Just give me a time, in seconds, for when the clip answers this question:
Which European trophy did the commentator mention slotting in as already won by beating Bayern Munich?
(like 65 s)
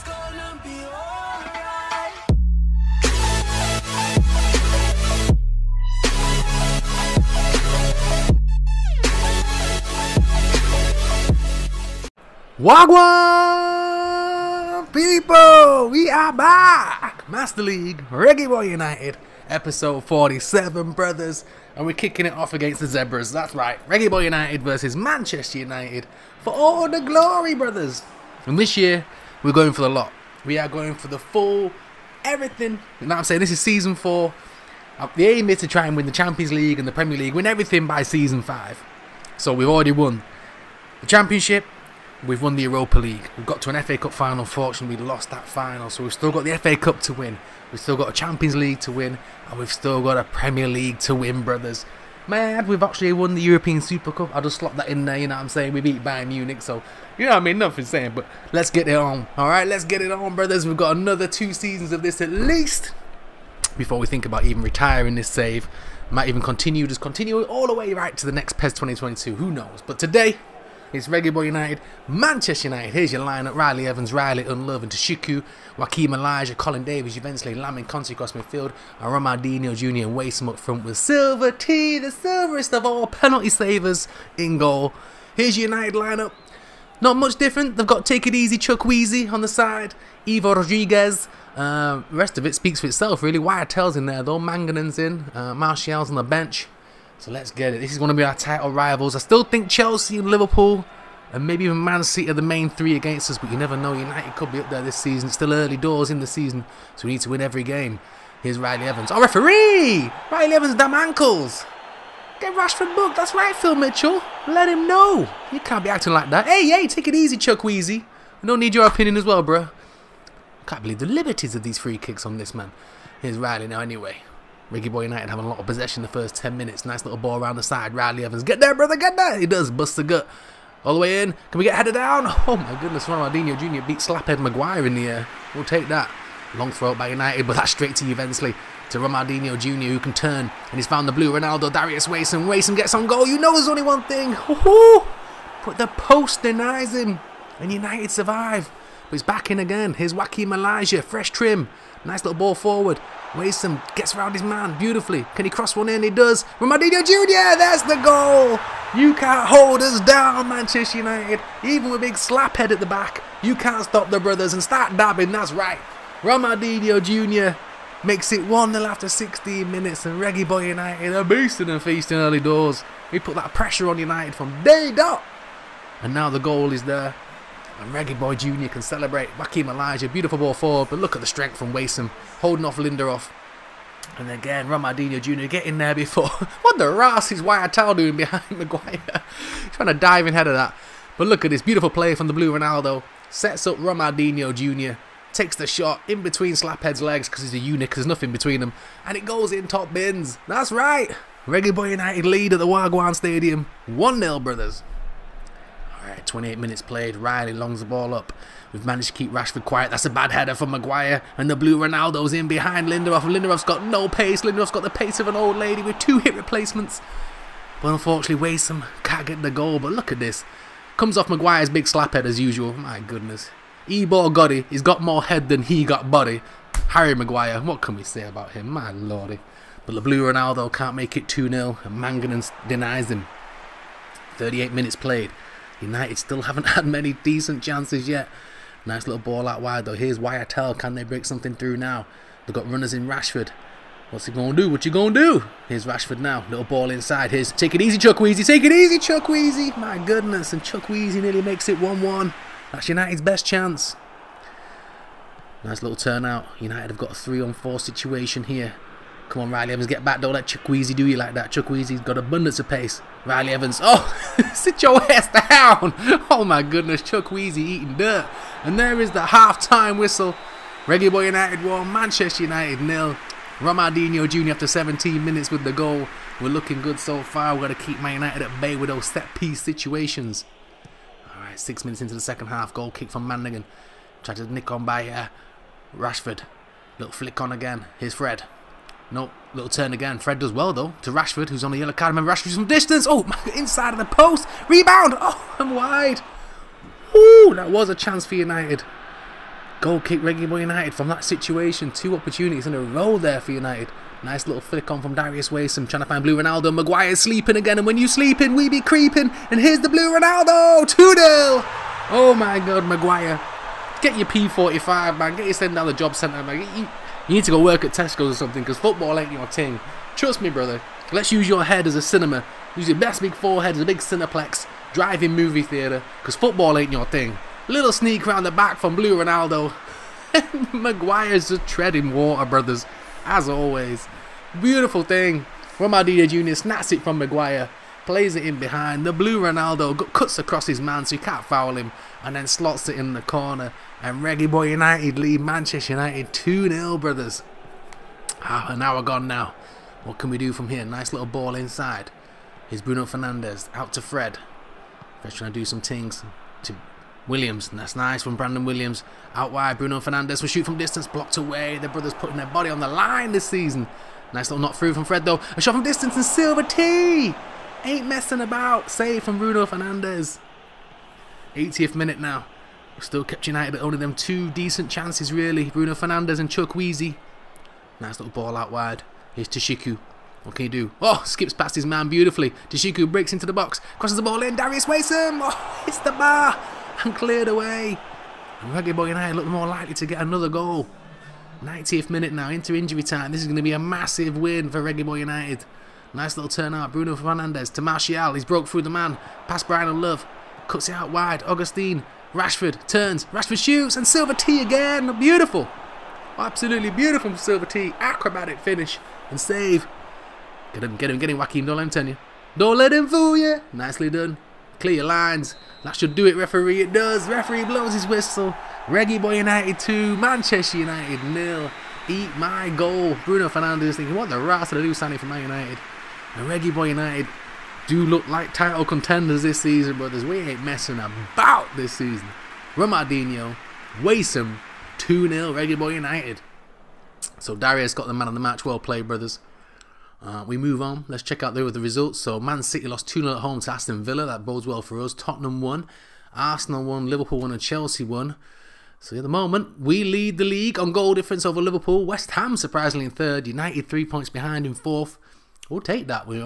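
53 s.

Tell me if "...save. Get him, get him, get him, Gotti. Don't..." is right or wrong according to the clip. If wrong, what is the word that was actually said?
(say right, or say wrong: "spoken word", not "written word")
wrong: "Joaquin", not "Gotti".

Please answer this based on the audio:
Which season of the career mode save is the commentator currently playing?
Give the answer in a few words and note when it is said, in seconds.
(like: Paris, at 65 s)
Season four, at 33 s.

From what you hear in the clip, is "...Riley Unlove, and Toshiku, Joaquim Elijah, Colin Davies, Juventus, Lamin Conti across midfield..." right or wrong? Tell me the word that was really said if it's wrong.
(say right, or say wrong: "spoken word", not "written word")
wrong: "Tashiku", not "Toshiku".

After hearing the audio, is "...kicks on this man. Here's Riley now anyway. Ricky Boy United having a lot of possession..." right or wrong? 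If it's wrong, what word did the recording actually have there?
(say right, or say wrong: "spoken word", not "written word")
right.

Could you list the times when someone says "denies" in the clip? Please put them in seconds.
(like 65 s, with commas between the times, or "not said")
146 s, 232 s.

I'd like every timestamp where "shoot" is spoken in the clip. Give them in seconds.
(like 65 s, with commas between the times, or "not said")
360 s, 403 s.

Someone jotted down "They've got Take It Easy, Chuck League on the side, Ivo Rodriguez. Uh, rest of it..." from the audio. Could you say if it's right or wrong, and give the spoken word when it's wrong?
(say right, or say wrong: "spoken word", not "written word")
wrong: "Wheezy", not "League".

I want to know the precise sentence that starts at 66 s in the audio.
Might even continue, just continue all the way right to the next PES 2022.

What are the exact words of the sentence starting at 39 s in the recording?
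So we've already won the Championship, we've won the Europa League.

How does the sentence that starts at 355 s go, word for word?
Fred's trying to do some things to Williams.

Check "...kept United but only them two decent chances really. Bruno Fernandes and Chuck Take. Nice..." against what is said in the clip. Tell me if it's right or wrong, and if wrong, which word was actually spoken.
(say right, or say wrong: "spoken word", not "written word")
wrong: "Weezy", not "Take".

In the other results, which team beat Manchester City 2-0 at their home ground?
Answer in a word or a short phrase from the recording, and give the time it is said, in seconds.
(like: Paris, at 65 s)
Aston Villa, at 443 s.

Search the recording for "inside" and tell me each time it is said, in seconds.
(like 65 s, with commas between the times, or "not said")
246 s, 293 s, 351 s.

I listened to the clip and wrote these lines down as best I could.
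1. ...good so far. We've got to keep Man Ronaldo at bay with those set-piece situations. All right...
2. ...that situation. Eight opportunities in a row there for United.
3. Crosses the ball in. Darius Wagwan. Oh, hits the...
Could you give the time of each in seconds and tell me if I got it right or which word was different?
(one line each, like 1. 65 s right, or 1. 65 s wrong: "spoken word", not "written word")
1. 276 s wrong: "United", not "Ronaldo"
2. 301 s wrong: "Two", not "Eight"
3. 383 s wrong: "Waysom", not "Wagwan".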